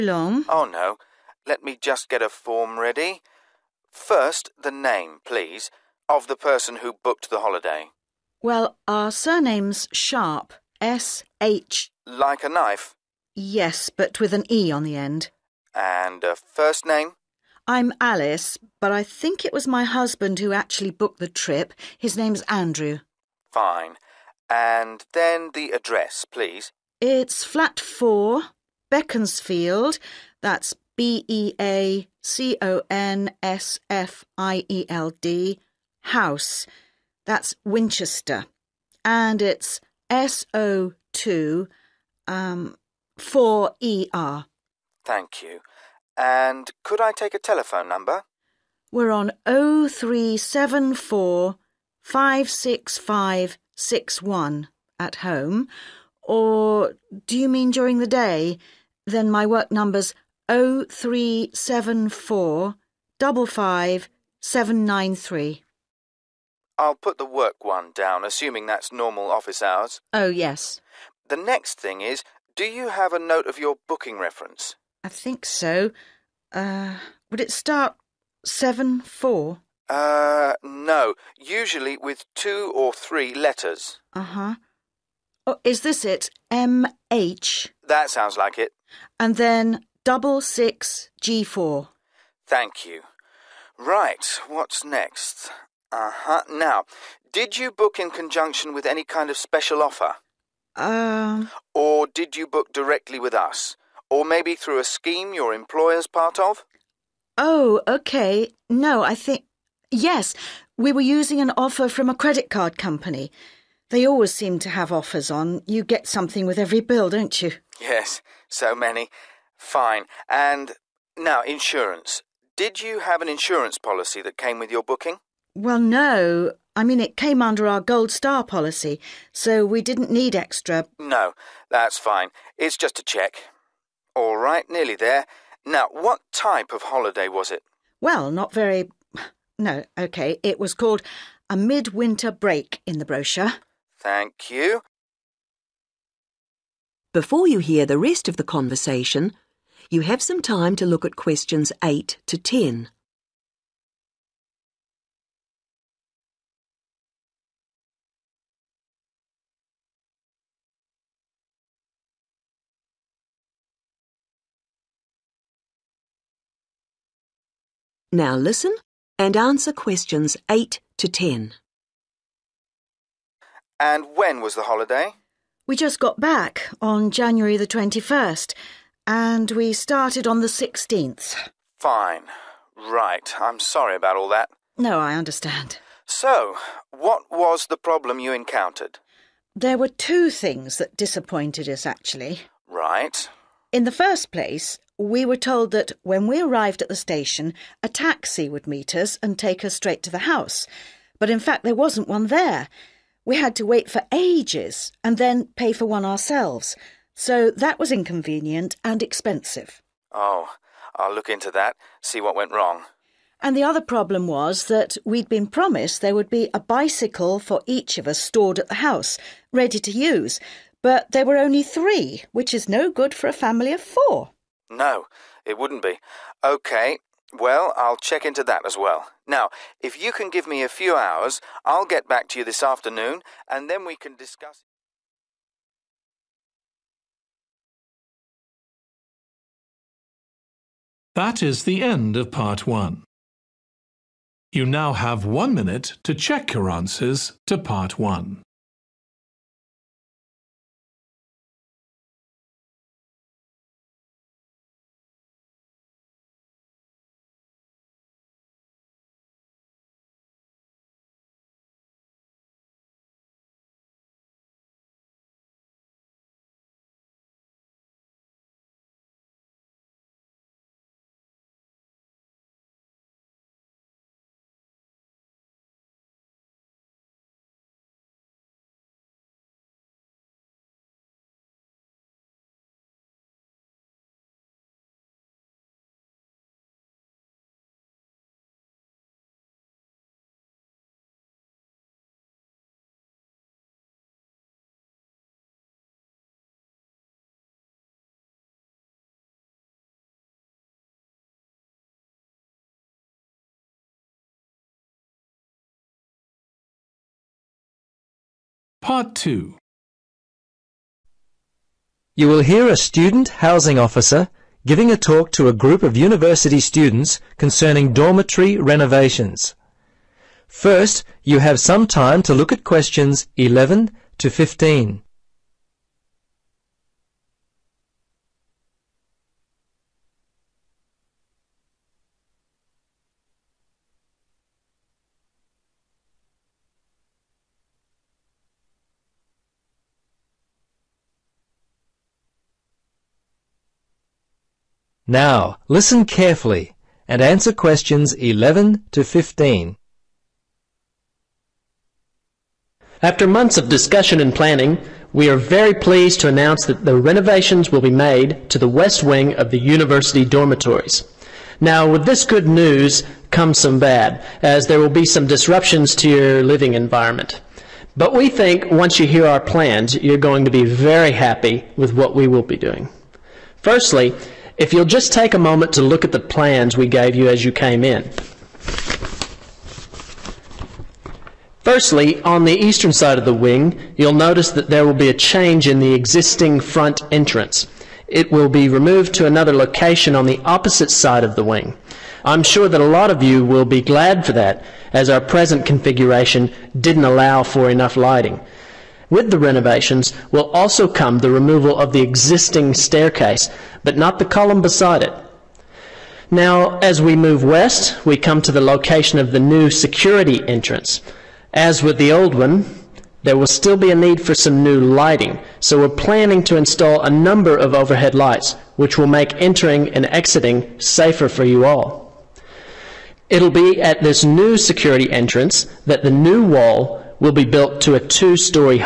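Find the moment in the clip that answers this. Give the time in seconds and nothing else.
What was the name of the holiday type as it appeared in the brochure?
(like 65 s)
141 s.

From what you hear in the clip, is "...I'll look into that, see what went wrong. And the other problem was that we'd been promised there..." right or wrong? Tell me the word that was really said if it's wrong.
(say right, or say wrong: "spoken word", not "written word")
right.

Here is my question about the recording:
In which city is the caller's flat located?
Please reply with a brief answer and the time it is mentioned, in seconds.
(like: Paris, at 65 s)
Winchester, at 37 s.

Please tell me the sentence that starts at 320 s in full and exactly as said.
First, you have some time to look at questions 11 to 15.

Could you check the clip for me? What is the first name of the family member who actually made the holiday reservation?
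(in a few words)
Andrew.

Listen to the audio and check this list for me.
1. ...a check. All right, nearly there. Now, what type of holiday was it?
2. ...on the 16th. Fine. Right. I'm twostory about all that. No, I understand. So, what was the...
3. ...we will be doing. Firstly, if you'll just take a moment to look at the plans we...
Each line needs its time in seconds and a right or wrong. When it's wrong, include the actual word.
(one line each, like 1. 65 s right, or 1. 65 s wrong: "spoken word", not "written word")
1. 132 s right
2. 180 s wrong: "sorry", not "twostory"
3. 372 s right.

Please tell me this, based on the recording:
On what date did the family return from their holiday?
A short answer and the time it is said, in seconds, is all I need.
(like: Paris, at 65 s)
January 21st, at 177 s.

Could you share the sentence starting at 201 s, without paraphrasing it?
But in fact, there wasn't one there.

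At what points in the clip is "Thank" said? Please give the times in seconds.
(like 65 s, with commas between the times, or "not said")
45 s, 92 s, 144 s.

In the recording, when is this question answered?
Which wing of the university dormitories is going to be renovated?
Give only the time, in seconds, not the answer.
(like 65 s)
358 s.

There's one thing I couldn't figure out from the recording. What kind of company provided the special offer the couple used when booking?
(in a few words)
credit card company.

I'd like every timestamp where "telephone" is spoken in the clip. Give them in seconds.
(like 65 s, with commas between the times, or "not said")
47 s.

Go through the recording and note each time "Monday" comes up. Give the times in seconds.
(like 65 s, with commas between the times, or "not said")
not said.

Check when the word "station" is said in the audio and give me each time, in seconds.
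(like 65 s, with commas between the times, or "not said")
196 s.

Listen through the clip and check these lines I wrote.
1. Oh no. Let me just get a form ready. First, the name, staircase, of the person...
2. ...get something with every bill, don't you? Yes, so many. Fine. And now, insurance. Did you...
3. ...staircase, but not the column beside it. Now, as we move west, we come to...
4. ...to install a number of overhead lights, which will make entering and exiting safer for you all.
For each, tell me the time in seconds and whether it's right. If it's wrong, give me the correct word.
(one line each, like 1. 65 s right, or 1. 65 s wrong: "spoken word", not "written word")
1. 0 s wrong: "please", not "staircase"
2. 115 s right
3. 402 s right
4. 416 s right.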